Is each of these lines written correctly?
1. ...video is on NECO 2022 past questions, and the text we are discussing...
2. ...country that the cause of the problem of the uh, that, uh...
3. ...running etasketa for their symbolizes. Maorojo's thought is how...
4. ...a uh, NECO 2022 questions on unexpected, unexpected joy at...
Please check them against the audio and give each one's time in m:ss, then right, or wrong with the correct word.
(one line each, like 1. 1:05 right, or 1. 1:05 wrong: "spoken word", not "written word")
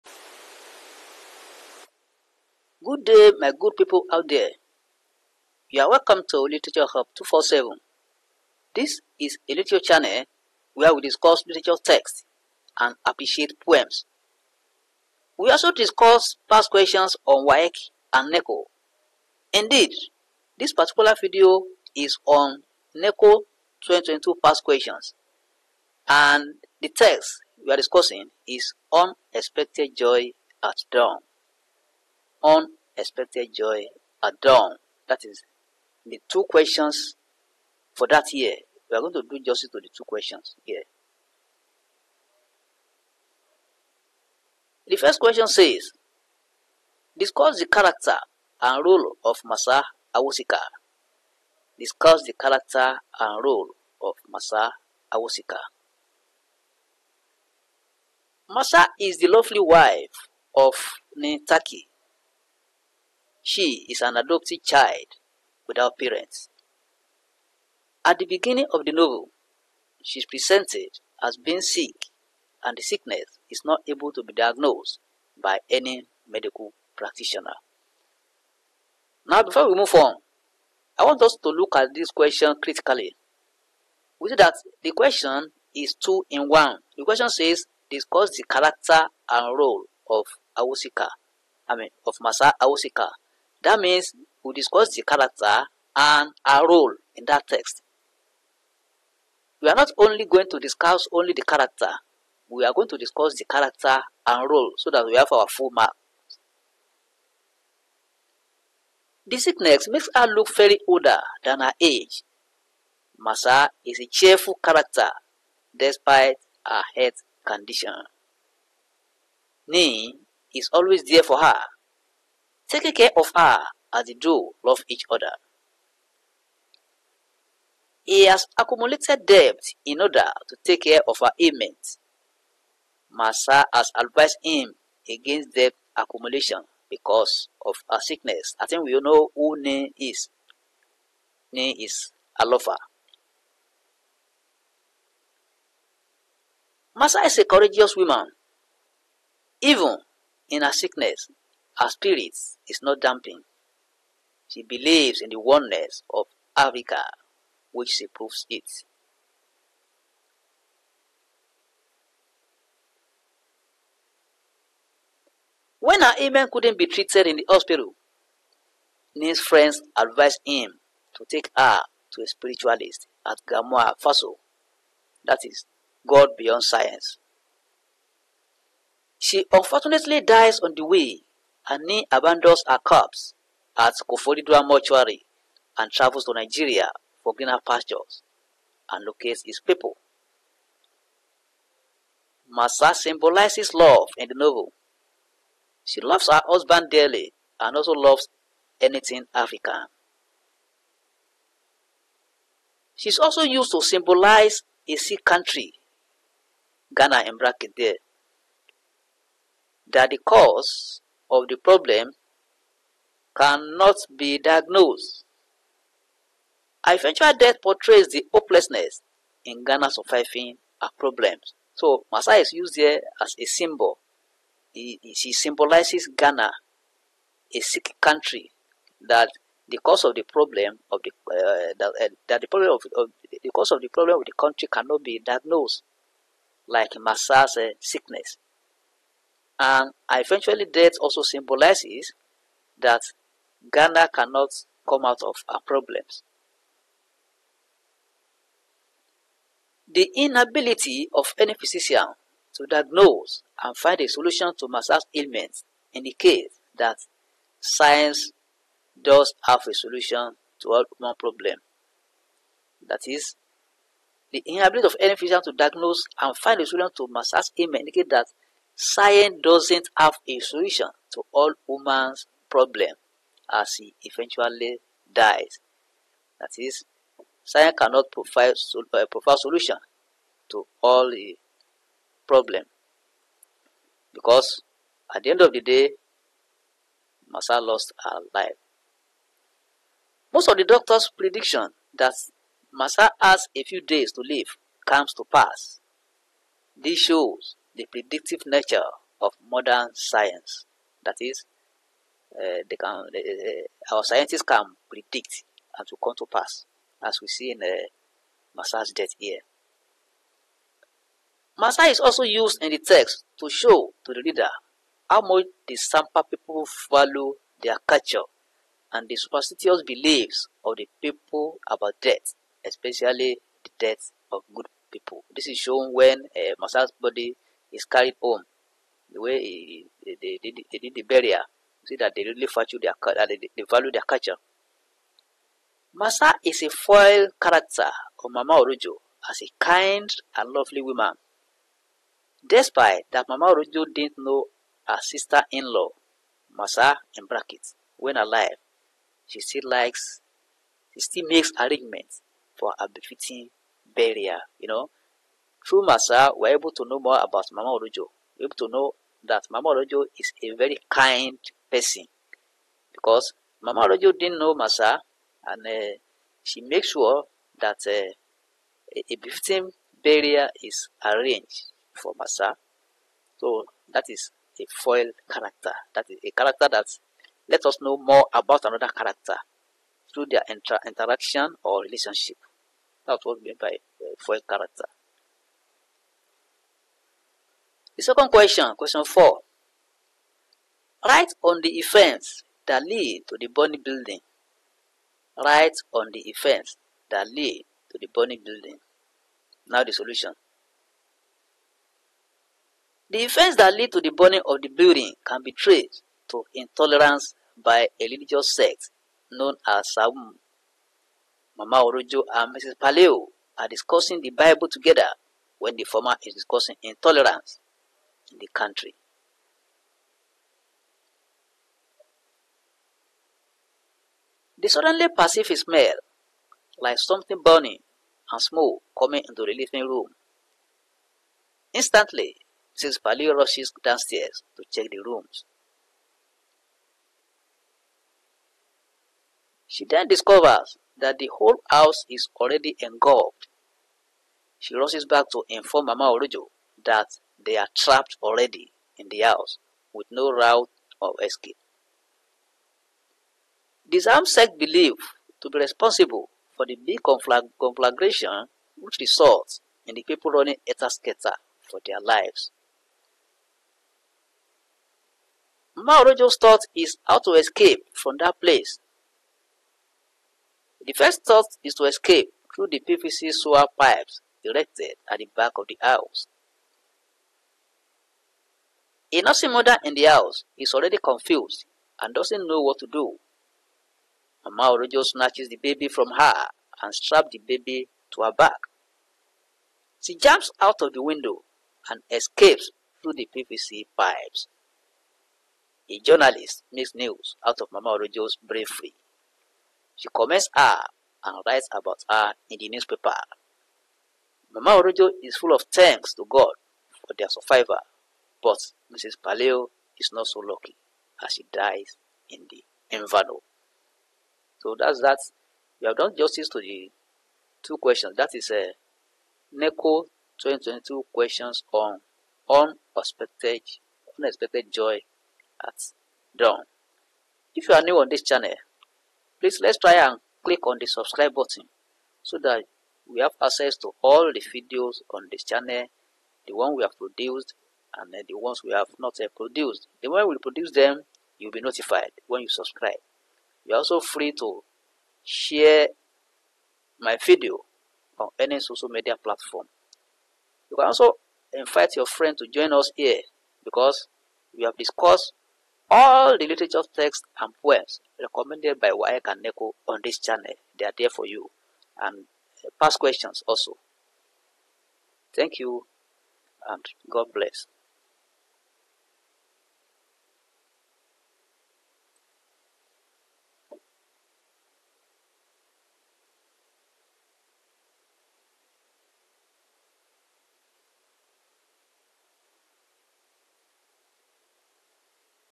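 1. 0:21 right
2. 3:48 right
3. 7:40 wrong: "lives", not "symbolizes"
4. 8:38 right.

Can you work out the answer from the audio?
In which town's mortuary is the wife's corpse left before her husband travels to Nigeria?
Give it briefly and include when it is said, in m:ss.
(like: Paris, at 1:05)
Koforidua, at 3:04.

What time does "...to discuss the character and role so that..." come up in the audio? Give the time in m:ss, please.
1:42.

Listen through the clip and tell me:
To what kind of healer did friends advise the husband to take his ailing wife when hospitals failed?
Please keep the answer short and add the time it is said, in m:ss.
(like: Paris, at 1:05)
A spiritualist, at 2:52.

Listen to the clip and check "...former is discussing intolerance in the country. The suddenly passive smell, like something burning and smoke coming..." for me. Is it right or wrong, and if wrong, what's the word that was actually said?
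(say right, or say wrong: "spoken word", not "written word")
right.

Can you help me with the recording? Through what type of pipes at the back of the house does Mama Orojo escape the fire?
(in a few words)
PVC sewer pipes.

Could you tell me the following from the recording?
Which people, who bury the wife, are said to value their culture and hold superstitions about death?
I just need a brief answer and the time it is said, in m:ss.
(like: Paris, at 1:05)
Sampa people, at 5:15.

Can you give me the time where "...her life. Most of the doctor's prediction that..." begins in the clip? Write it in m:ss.
4:48.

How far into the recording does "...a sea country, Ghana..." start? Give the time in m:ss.
3:24.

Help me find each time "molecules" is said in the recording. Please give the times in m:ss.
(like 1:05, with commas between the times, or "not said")
not said.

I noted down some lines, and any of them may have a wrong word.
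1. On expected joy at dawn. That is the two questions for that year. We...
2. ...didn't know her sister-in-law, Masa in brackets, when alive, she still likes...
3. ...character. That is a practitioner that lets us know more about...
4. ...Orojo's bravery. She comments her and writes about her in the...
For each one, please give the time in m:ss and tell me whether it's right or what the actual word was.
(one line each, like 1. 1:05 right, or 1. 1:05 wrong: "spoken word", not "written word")
1. 0:32 right
2. 5:43 right
3. 6:15 wrong: "character", not "practitioner"
4. 8:17 right.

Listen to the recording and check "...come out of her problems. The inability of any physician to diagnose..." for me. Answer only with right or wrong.
right.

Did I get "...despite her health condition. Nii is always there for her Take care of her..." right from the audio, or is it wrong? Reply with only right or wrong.
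right.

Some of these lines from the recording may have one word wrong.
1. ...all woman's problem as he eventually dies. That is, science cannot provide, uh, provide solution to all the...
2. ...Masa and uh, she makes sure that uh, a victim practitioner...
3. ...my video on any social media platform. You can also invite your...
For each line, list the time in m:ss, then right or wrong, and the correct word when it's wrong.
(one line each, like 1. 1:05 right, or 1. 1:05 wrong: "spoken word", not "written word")
1. 4:31 right
2. 6:04 wrong: "barrier", not "practitioner"
3. 9:06 right.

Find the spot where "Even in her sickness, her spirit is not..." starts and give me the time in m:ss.
2:29.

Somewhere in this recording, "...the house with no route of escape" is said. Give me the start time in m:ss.
7:29.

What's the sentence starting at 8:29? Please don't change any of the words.
Paleo is not so lucky as she dies in the inferno.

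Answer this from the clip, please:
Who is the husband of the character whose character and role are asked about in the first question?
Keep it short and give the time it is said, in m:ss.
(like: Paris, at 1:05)
Nii Tackie, at 1:01.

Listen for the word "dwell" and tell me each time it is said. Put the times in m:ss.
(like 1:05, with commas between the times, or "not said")
not said.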